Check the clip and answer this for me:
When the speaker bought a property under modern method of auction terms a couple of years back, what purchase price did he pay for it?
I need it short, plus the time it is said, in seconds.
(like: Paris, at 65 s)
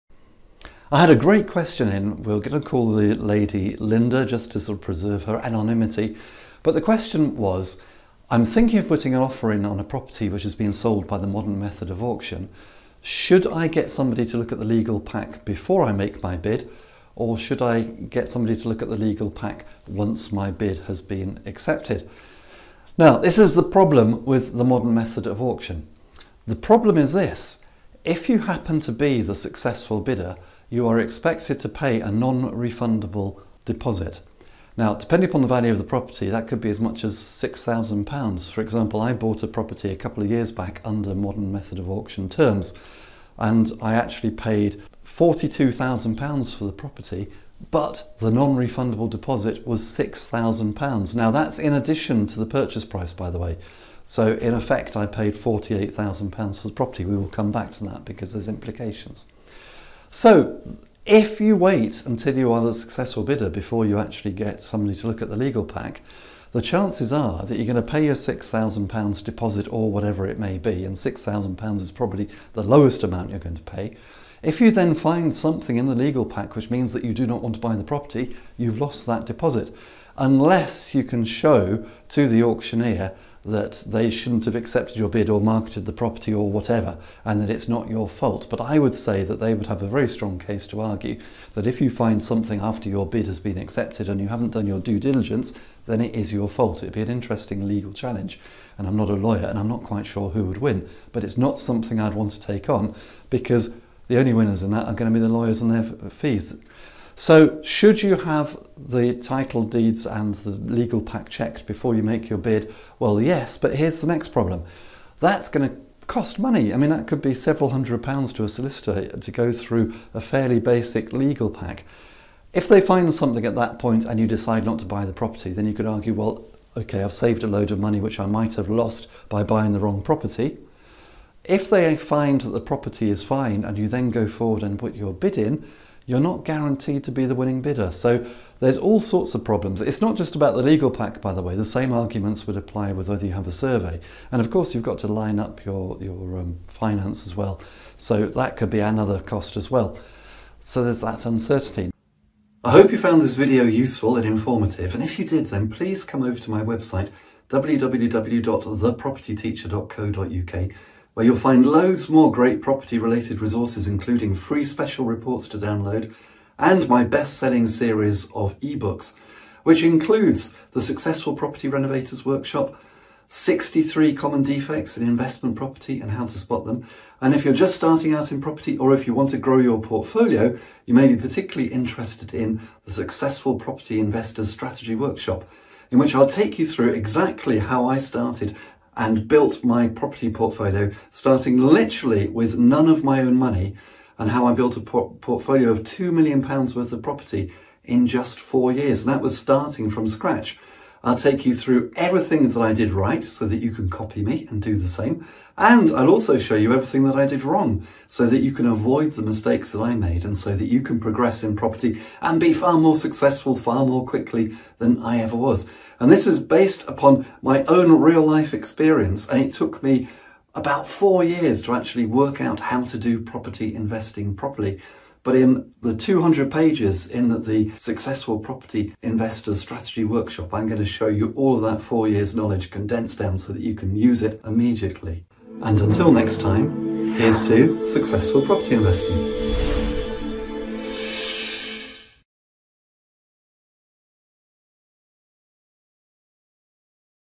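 £42,000, at 45 s.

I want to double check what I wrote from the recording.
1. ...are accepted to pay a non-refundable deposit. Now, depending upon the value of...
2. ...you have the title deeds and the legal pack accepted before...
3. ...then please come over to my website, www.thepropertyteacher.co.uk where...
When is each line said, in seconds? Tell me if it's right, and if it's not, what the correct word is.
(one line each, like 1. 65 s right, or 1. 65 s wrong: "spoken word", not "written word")
1. 30 s wrong: "expected", not "accepted"
2. 108 s wrong: "checked", not "accepted"
3. 155 s right.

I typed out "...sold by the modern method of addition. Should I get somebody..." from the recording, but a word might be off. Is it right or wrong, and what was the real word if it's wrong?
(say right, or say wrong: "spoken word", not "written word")
wrong: "auction", not "addition".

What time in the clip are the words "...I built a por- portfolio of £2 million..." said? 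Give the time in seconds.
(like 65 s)
194 s.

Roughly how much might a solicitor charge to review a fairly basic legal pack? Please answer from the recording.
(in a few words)
several hundred pounds.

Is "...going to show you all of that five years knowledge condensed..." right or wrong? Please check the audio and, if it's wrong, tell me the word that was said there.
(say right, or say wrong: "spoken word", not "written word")
wrong: "four", not "five".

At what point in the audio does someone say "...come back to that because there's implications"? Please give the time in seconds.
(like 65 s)
57 s.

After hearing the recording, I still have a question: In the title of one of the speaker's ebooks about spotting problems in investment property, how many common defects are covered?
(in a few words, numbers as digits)
63.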